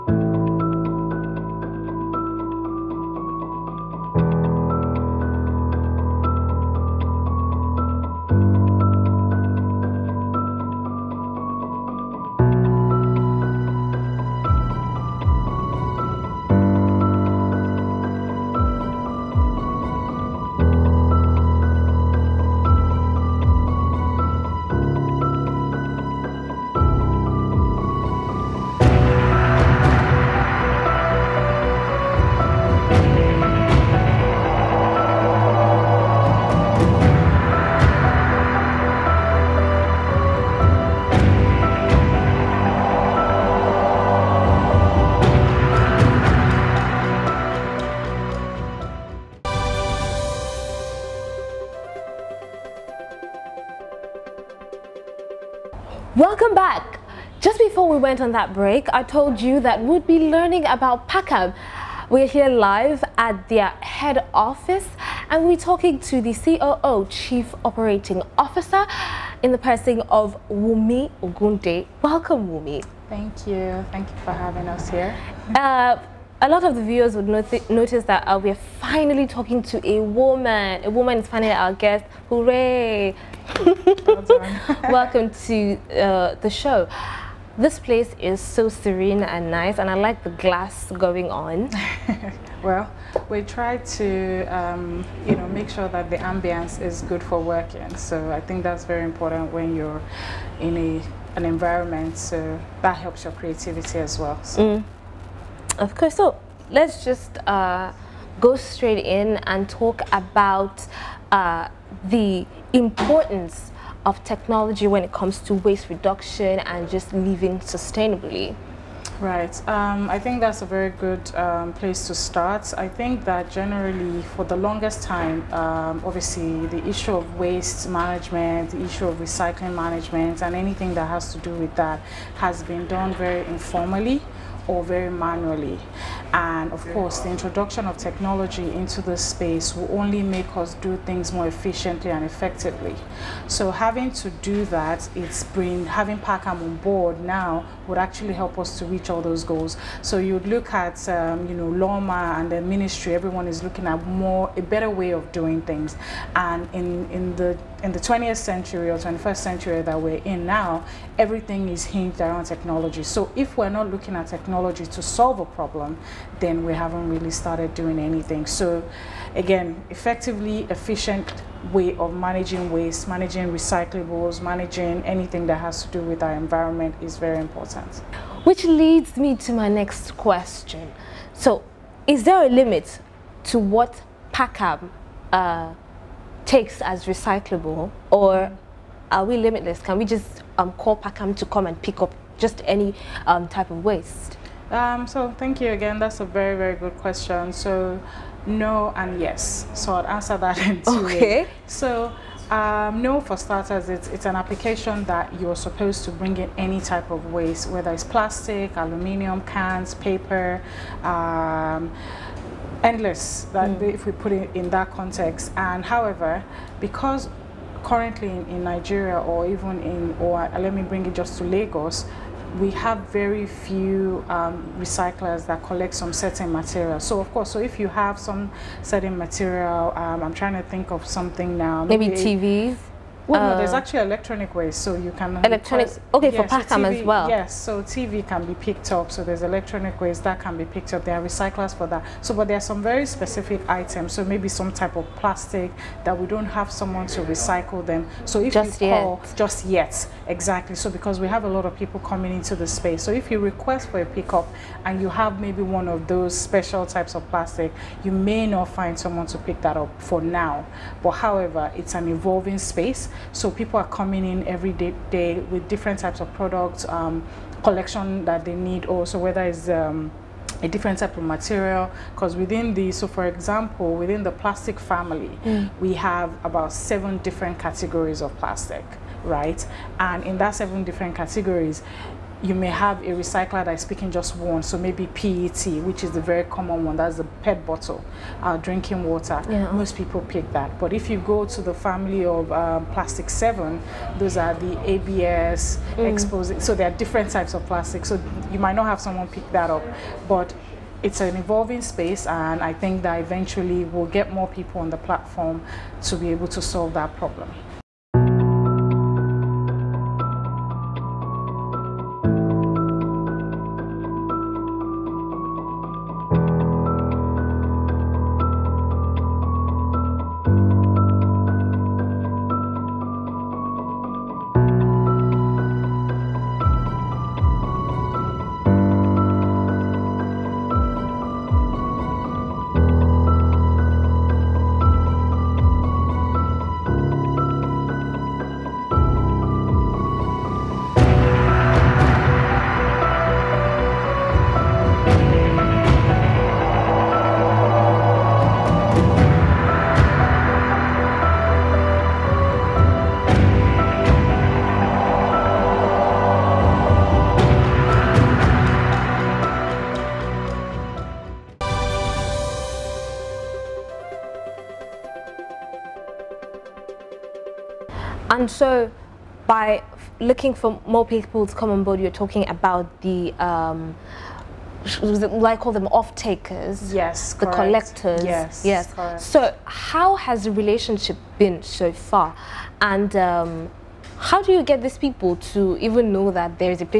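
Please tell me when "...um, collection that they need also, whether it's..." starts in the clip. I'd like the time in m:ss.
4:26.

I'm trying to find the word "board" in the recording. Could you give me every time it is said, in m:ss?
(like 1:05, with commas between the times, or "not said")
2:26, 6:11.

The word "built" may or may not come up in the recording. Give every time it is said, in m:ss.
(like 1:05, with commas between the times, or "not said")
not said.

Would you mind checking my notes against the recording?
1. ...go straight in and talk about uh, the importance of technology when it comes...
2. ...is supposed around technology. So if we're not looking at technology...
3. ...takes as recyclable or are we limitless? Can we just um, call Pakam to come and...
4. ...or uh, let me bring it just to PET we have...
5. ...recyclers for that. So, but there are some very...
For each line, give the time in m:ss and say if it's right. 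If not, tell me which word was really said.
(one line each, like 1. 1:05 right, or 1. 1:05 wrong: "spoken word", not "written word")
1. 1:48 right
2. 2:41 wrong: "hinged", not "supposed"
3. 3:06 right
4. 3:40 wrong: "Lagos", not "PET"
5. 4:01 right.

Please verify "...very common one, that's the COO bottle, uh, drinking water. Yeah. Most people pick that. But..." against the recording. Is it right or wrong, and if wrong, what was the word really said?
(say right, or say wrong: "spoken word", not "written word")
wrong: "PET", not "COO".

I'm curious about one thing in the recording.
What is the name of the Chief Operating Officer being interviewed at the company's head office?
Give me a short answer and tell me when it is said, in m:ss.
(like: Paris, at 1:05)
Wunmi Ogunde, at 1:10.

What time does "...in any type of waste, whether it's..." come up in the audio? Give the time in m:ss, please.
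3:26.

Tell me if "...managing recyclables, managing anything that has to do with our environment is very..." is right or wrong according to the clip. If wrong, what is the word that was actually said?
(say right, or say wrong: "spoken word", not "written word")
right.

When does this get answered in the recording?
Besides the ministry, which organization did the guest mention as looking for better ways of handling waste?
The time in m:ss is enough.
2:31.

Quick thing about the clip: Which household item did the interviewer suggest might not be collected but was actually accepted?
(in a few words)
TVs.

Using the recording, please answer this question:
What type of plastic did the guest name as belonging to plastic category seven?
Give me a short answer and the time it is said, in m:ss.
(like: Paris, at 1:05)
ABS, at 4:54.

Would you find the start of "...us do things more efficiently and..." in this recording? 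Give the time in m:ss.
2:20.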